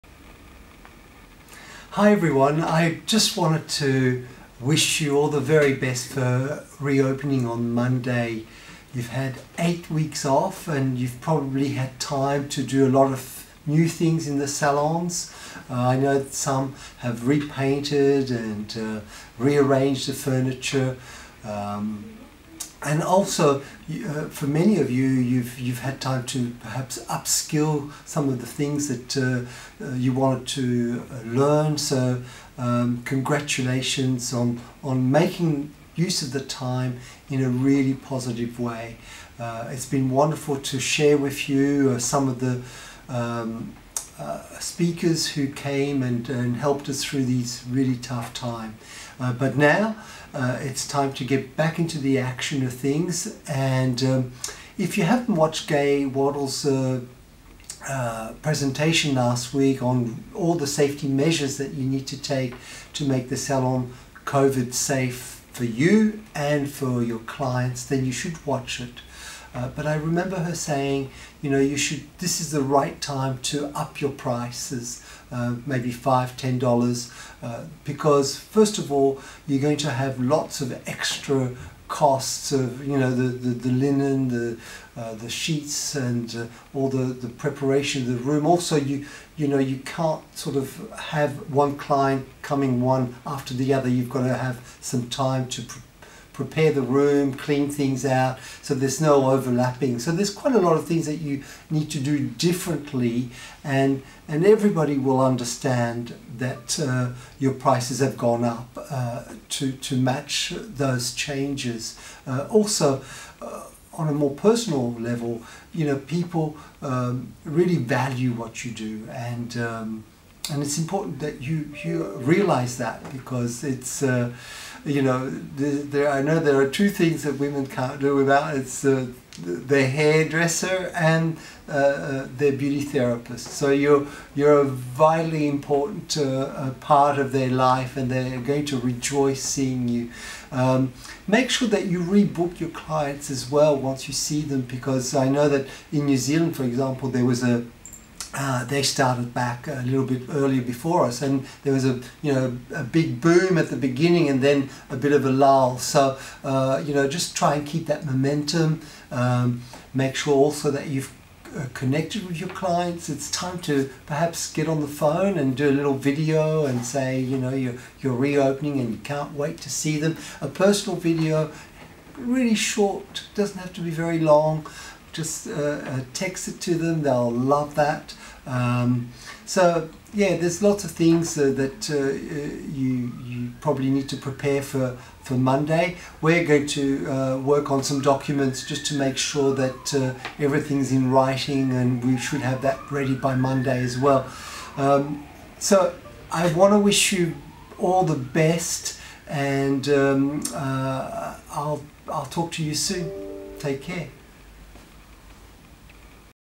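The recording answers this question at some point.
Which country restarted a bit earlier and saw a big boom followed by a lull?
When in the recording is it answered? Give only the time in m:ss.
2:26.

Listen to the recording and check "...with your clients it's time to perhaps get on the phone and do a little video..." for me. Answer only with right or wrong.
right.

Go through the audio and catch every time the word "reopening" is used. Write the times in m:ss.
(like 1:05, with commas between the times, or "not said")
0:06, 2:48.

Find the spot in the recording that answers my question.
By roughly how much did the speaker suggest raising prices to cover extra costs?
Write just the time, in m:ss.
1:15.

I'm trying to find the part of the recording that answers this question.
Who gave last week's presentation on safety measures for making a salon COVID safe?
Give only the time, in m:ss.
0:55.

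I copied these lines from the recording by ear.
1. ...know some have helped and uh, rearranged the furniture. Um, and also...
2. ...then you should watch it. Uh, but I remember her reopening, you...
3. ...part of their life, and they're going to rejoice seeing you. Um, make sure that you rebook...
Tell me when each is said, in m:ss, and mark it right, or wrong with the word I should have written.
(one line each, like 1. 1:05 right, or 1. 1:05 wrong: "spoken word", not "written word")
1. 0:15 wrong: "repainted", not "helped"
2. 1:07 wrong: "saying", not "reopening"
3. 2:16 right.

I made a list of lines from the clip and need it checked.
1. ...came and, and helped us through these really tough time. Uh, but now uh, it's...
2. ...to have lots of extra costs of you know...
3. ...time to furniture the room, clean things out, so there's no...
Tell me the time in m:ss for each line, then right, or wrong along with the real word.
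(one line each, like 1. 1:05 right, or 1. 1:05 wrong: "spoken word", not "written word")
1. 0:45 right
2. 1:19 right
3. 1:35 wrong: "prepare", not "furniture".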